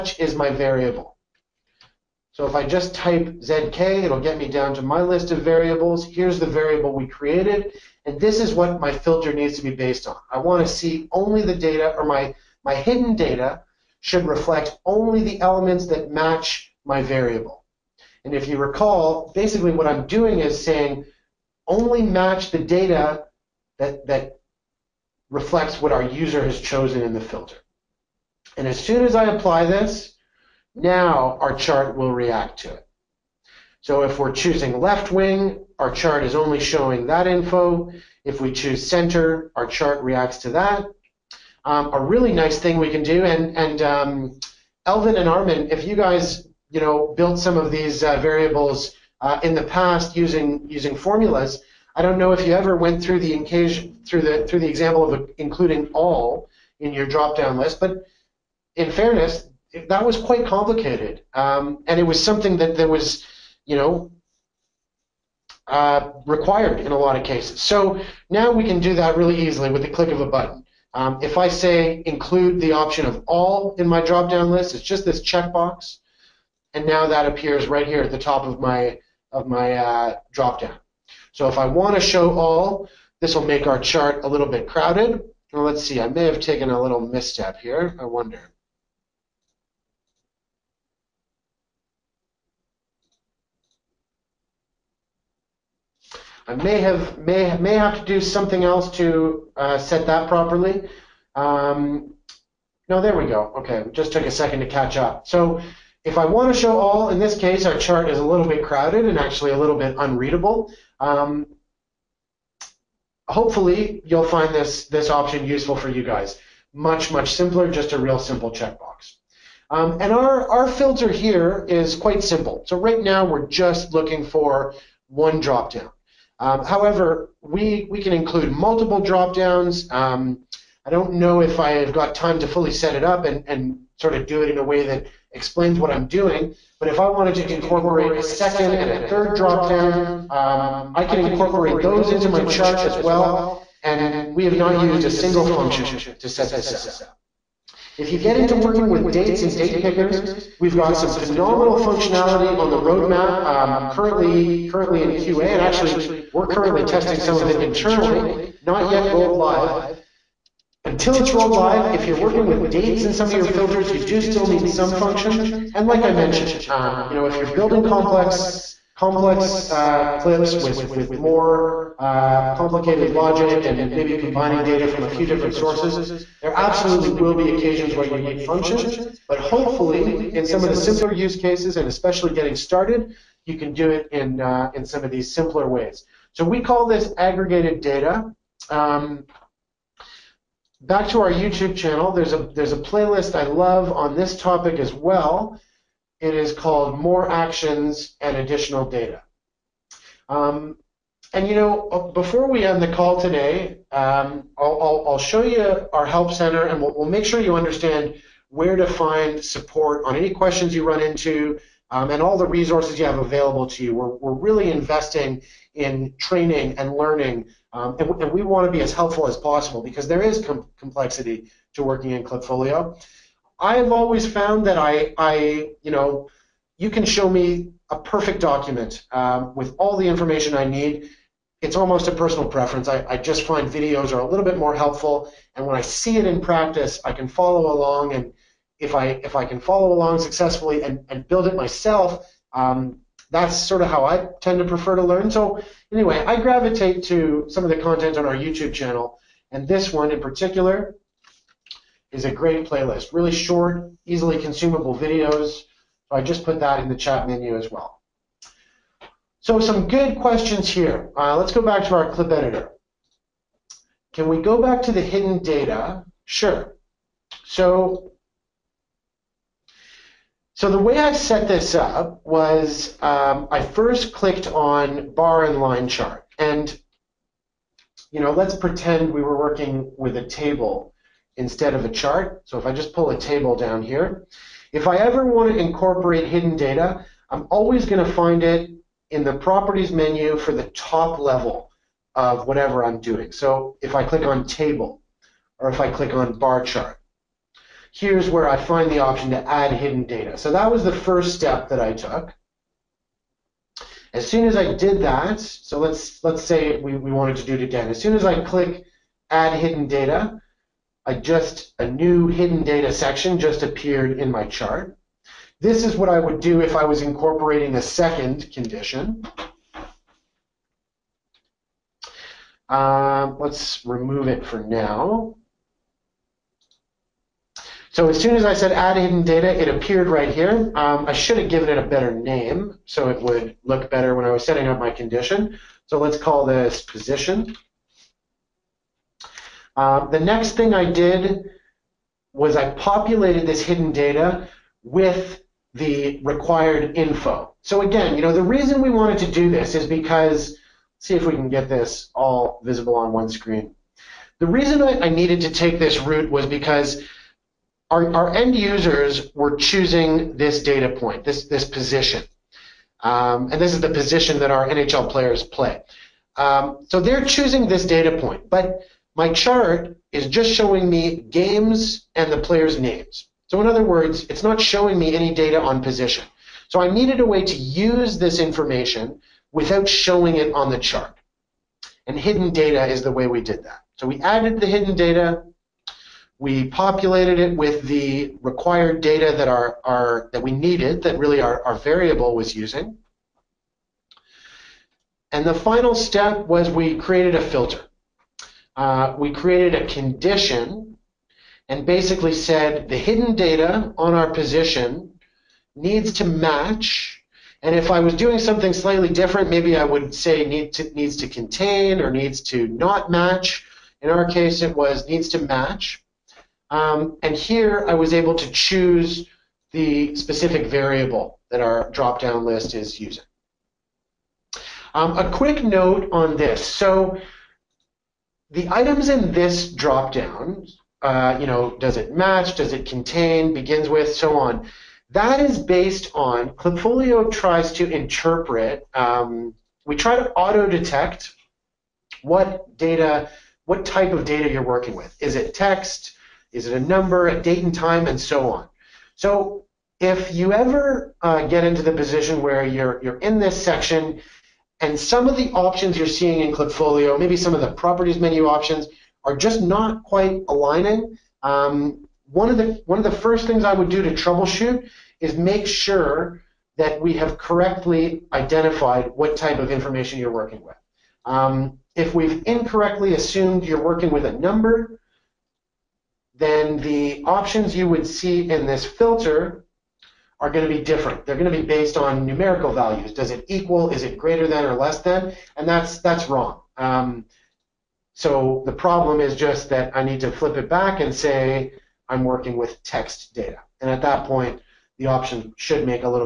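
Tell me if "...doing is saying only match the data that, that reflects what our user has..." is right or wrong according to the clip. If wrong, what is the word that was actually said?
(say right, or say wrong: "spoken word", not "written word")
right.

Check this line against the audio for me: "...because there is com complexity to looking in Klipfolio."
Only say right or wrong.
wrong.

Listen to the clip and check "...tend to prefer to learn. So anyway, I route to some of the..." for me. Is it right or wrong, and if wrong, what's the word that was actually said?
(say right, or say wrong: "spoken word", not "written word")
wrong: "gravitate", not "route".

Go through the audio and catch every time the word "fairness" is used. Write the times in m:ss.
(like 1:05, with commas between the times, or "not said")
0:58.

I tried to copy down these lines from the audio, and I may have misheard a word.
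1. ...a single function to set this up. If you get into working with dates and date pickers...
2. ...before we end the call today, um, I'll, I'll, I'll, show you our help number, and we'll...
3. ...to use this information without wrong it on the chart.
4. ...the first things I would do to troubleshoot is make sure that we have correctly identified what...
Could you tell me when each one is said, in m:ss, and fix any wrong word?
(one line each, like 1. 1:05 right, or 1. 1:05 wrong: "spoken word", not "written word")
1. 2:25 right
2. 3:22 wrong: "center", not "number"
3. 6:17 wrong: "showing", not "wrong"
4. 7:43 right.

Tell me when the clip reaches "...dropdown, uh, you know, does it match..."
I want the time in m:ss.
7:09.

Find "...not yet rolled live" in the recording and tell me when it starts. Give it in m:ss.
2:38.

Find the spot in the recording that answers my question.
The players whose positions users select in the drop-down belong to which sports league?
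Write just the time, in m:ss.
6:04.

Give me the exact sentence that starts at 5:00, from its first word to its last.
So that was the first step that I took.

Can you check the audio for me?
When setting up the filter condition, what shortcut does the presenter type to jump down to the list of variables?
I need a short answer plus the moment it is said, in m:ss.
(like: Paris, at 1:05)
ZK, at 0:03.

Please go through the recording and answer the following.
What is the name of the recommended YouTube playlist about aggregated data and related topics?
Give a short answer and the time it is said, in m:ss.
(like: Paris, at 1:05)
More Actions and Additional Data, at 3:16.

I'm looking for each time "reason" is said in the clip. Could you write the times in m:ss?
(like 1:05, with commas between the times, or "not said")
5:48, 5:54.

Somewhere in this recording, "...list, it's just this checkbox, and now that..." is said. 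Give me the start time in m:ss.
1:14.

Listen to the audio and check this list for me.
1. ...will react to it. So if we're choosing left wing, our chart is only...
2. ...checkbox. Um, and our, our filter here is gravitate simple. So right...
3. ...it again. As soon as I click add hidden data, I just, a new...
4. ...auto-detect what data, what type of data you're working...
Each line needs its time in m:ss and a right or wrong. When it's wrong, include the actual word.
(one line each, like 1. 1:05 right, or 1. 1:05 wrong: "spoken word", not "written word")
1. 0:31 right
2. 1:58 wrong: "quite", not "gravitate"
3. 5:07 right
4. 7:20 right.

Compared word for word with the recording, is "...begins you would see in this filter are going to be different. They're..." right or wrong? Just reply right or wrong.
wrong.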